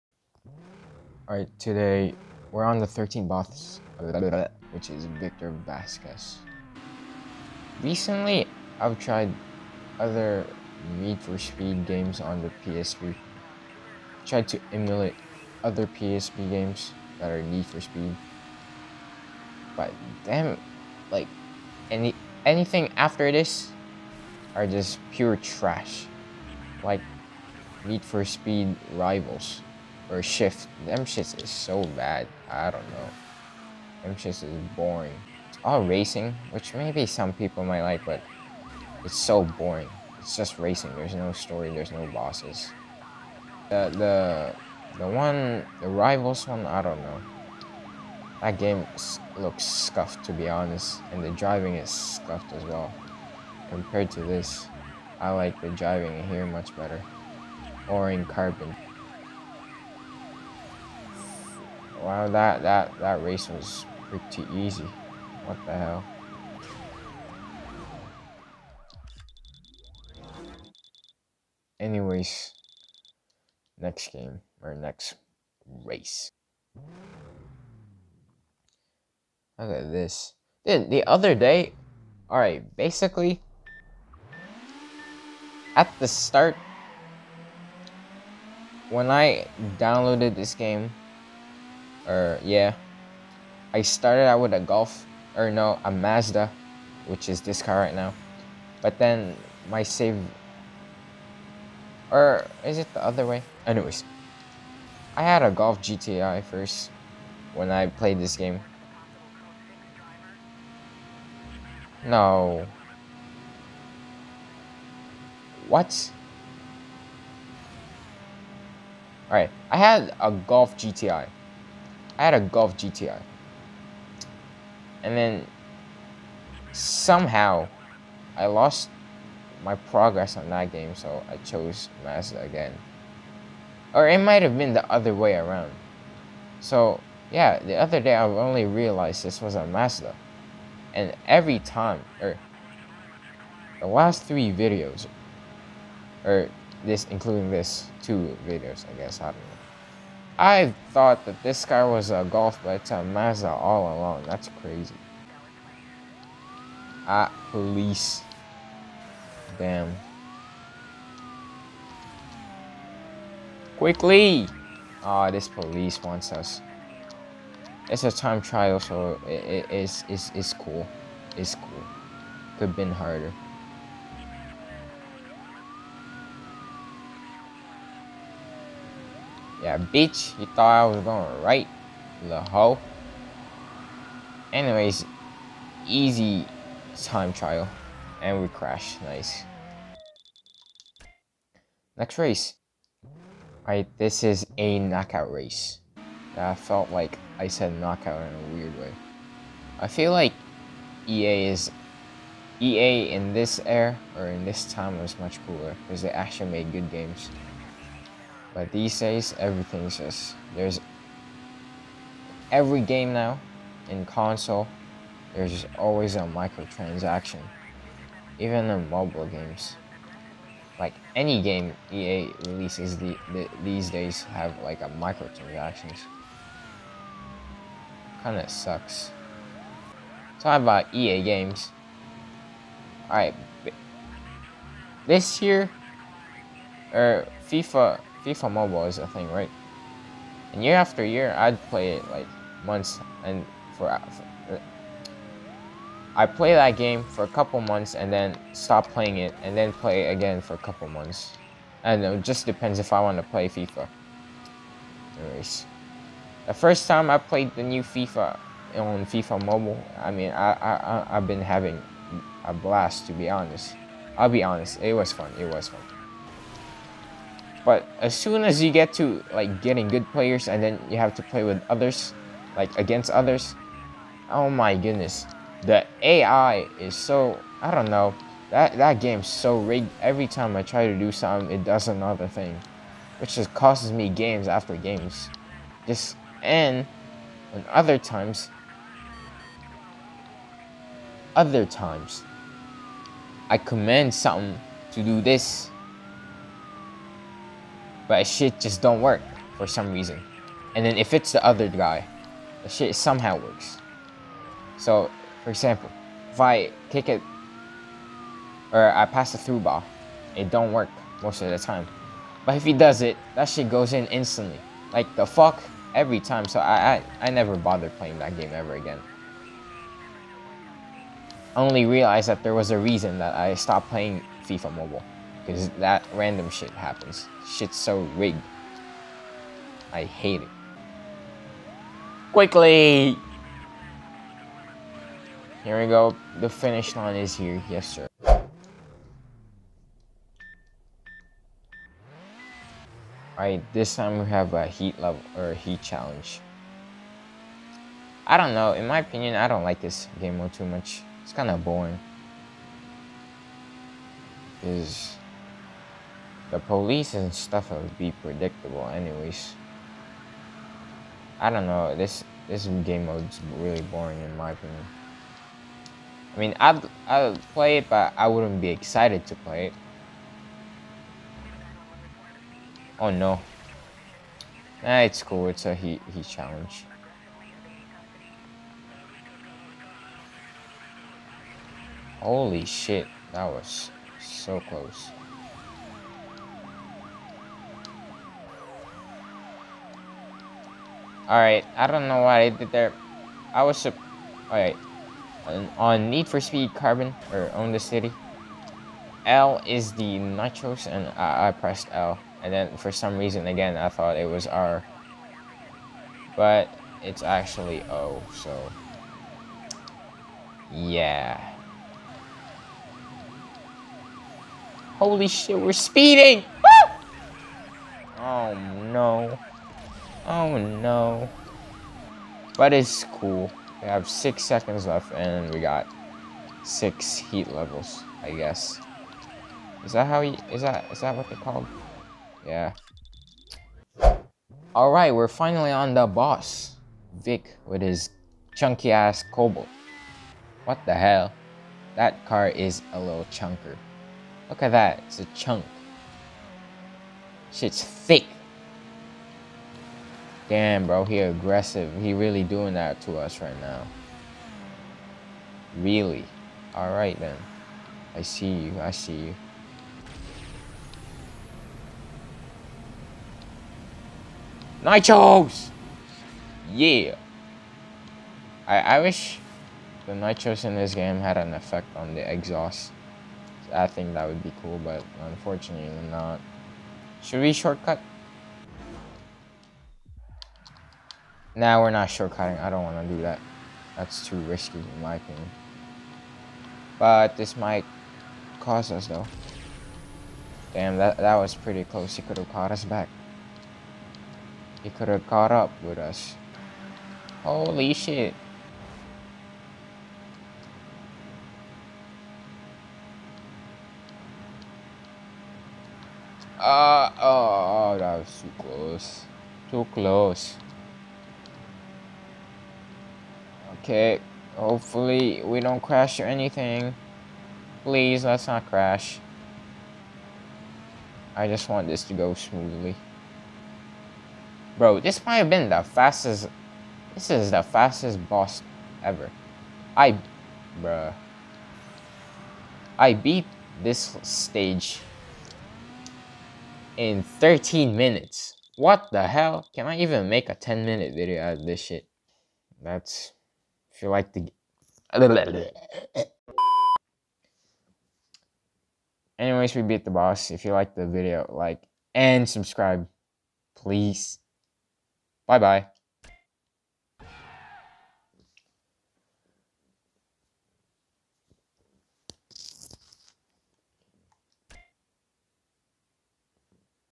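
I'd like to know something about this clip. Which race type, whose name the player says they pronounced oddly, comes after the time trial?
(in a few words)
Knockout race.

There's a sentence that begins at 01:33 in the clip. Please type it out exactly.
I started out with a Golf, or no, a Mazda, which is this car right now.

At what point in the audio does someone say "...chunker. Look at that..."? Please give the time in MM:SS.
07:23.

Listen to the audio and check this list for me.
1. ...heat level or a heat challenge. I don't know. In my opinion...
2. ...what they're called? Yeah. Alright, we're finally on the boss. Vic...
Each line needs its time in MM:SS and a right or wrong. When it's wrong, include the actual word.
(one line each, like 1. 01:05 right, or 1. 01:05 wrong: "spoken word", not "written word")
1. 05:44 right
2. 07:11 right.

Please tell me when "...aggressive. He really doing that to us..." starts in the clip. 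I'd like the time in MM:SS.
07:31.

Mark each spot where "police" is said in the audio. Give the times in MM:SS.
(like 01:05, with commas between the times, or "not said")
02:37, 02:45, 05:56.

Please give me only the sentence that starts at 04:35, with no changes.
The AI is so I don't know.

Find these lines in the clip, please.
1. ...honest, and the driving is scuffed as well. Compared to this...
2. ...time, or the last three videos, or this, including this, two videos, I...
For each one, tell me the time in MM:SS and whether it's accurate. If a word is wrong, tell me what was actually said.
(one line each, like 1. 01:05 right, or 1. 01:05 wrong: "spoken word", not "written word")
1. 00:50 right
2. 02:21 right.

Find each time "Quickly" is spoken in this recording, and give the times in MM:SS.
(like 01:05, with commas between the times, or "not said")
02:43, 05:32.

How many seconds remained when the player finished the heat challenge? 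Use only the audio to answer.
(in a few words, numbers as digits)
6.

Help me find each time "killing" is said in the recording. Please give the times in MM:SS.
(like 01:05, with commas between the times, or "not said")
not said.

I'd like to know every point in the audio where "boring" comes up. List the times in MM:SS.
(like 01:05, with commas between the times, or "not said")
00:34, 00:39, 05:51, 06:03.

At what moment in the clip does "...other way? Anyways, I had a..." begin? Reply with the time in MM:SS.
01:43.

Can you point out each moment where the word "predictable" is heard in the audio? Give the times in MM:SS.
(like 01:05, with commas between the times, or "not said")
05:58.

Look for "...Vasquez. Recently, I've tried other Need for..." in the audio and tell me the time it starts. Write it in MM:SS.
00:05.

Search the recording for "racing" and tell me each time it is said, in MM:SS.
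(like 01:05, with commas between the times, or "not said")
00:35, 00:40.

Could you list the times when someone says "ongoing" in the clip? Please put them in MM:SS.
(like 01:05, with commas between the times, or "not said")
not said.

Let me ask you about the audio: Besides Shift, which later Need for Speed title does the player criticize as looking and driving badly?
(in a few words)
Need for Speed Rivals.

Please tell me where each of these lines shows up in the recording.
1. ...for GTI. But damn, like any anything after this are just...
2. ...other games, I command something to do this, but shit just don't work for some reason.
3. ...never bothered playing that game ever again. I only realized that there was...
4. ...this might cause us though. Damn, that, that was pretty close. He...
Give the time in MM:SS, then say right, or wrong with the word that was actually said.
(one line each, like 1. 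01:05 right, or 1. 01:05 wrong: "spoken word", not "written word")
1. 00:17 wrong: "Speed", not "GTI"
2. 04:51 wrong: "times", not "games"
3. 05:17 right
4. 08:07 right.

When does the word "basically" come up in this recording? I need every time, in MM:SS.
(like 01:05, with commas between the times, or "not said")
01:22.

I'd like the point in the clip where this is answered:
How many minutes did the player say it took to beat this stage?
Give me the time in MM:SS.
08:57.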